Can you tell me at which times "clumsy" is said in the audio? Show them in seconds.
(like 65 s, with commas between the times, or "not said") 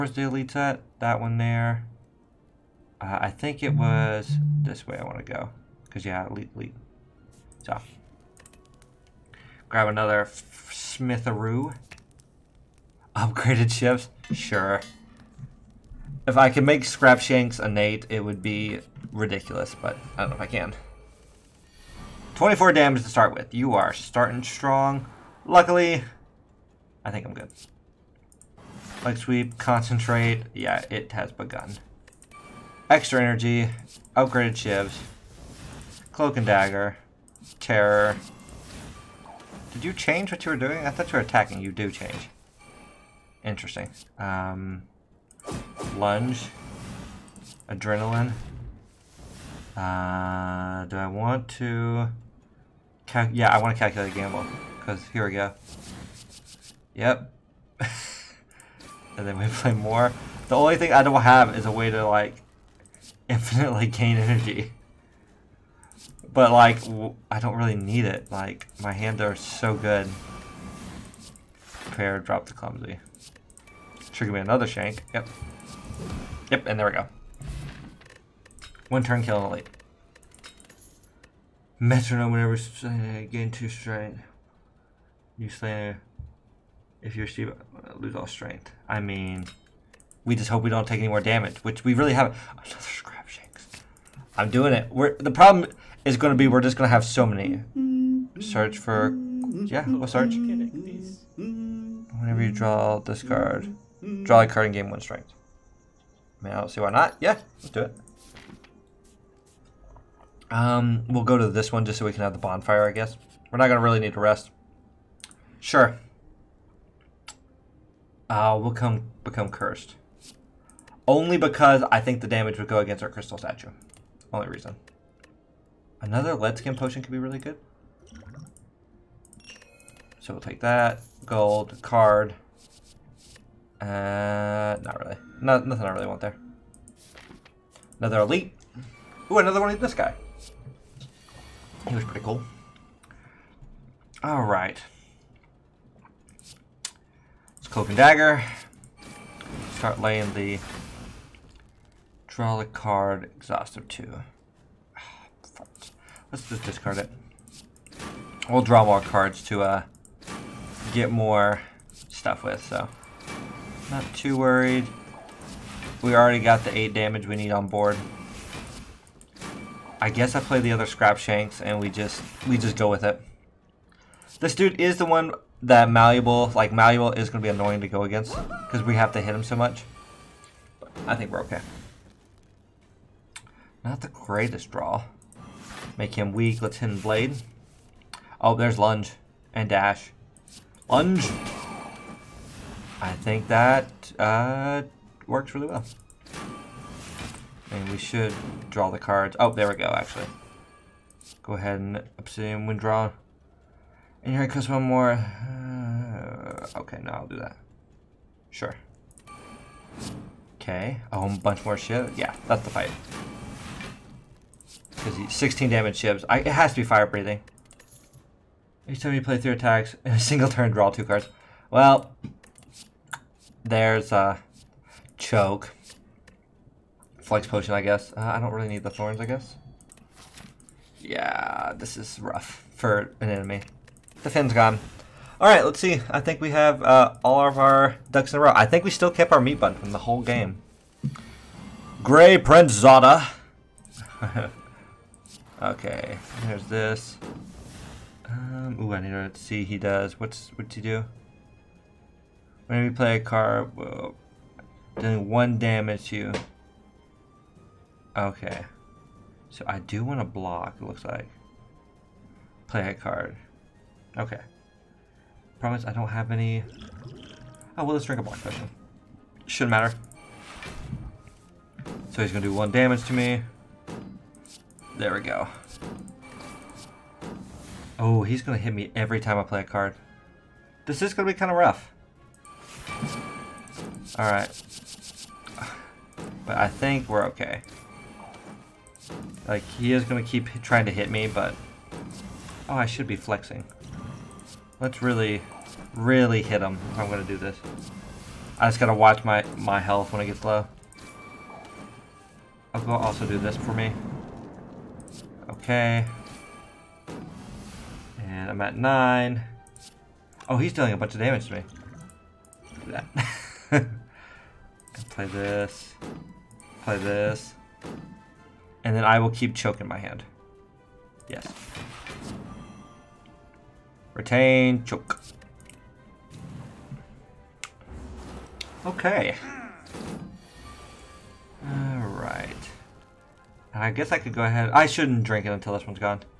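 72 s.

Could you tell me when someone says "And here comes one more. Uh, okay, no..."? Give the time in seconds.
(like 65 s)
204 s.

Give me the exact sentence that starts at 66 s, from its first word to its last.
But, like, I don't really need it.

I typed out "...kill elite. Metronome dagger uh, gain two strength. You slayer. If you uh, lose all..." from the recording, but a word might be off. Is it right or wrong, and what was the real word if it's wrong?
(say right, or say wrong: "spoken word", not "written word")
wrong: "whenever", not "dagger".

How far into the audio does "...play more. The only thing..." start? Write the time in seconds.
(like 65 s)
59 s.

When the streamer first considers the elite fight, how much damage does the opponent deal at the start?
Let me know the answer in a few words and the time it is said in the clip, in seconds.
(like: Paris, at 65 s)
24, at 22 s.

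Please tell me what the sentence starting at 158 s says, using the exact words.
We'll draw more cards to uh, get more stuff with.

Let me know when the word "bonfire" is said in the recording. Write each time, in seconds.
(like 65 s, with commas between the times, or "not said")
112 s.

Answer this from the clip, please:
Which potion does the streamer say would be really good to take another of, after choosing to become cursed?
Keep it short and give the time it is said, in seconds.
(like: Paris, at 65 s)
Lead skin potion, at 126 s.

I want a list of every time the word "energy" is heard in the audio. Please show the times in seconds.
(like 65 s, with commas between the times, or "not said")
33 s, 64 s.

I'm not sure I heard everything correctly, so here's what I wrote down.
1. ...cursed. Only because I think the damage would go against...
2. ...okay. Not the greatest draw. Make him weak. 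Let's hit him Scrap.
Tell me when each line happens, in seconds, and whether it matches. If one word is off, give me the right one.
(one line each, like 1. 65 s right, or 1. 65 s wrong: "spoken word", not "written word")
1. 119 s right
2. 181 s wrong: "Blade", not "Scrap".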